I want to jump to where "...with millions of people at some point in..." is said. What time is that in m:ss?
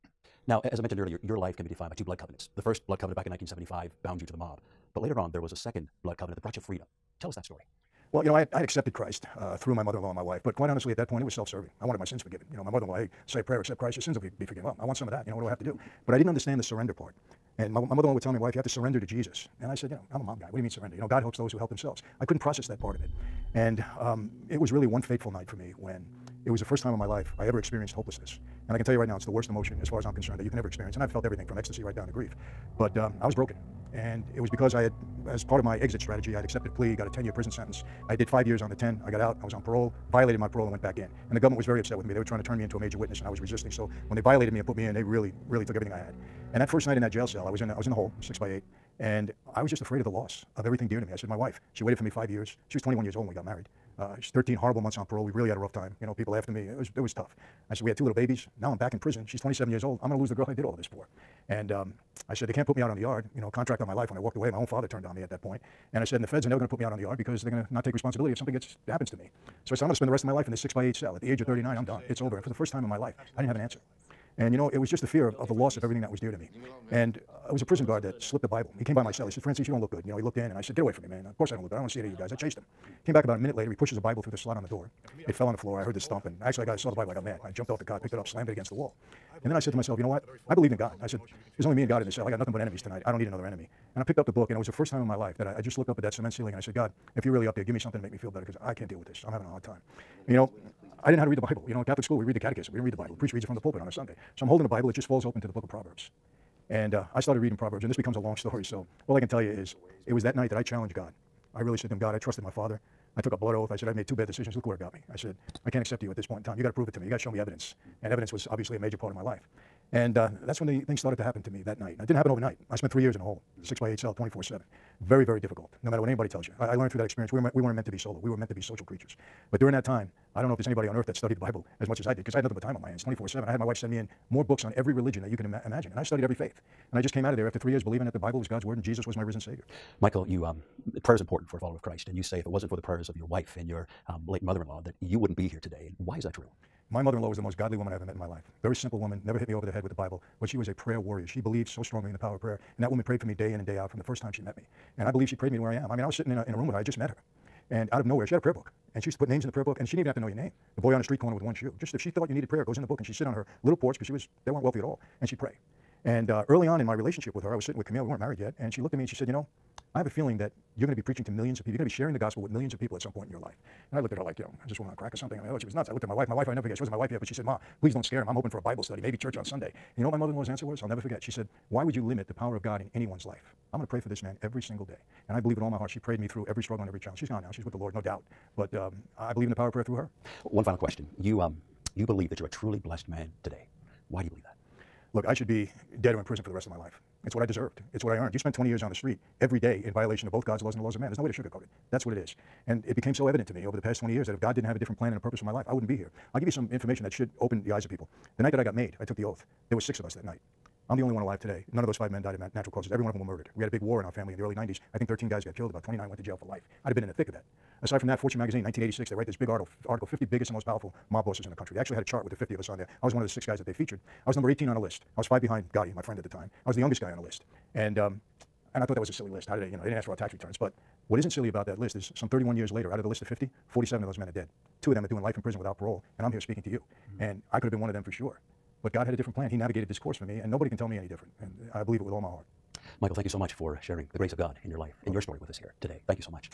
2:52.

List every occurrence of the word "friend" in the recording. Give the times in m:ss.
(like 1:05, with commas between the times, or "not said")
3:46.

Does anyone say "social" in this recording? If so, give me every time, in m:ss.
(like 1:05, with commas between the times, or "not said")
2:08.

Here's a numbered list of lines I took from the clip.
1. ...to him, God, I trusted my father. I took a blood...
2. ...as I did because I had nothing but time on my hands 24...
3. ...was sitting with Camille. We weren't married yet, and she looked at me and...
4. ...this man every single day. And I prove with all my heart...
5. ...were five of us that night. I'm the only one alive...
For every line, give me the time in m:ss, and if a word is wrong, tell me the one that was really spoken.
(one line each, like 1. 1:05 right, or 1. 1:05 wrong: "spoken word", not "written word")
1. 1:51 right
2. 2:11 right
3. 2:47 right
4. 3:04 wrong: "believe", not "prove"
5. 3:29 wrong: "six", not "five".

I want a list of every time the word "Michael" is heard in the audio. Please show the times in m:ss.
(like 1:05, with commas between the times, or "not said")
2:20, 4:03.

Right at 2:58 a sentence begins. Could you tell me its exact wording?
I'm hoping for a Bible study, maybe church on Sunday.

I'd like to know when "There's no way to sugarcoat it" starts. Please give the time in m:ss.
3:21.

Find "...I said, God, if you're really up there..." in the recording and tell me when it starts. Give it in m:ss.
1:36.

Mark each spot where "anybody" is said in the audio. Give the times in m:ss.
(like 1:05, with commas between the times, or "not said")
2:06, 2:10.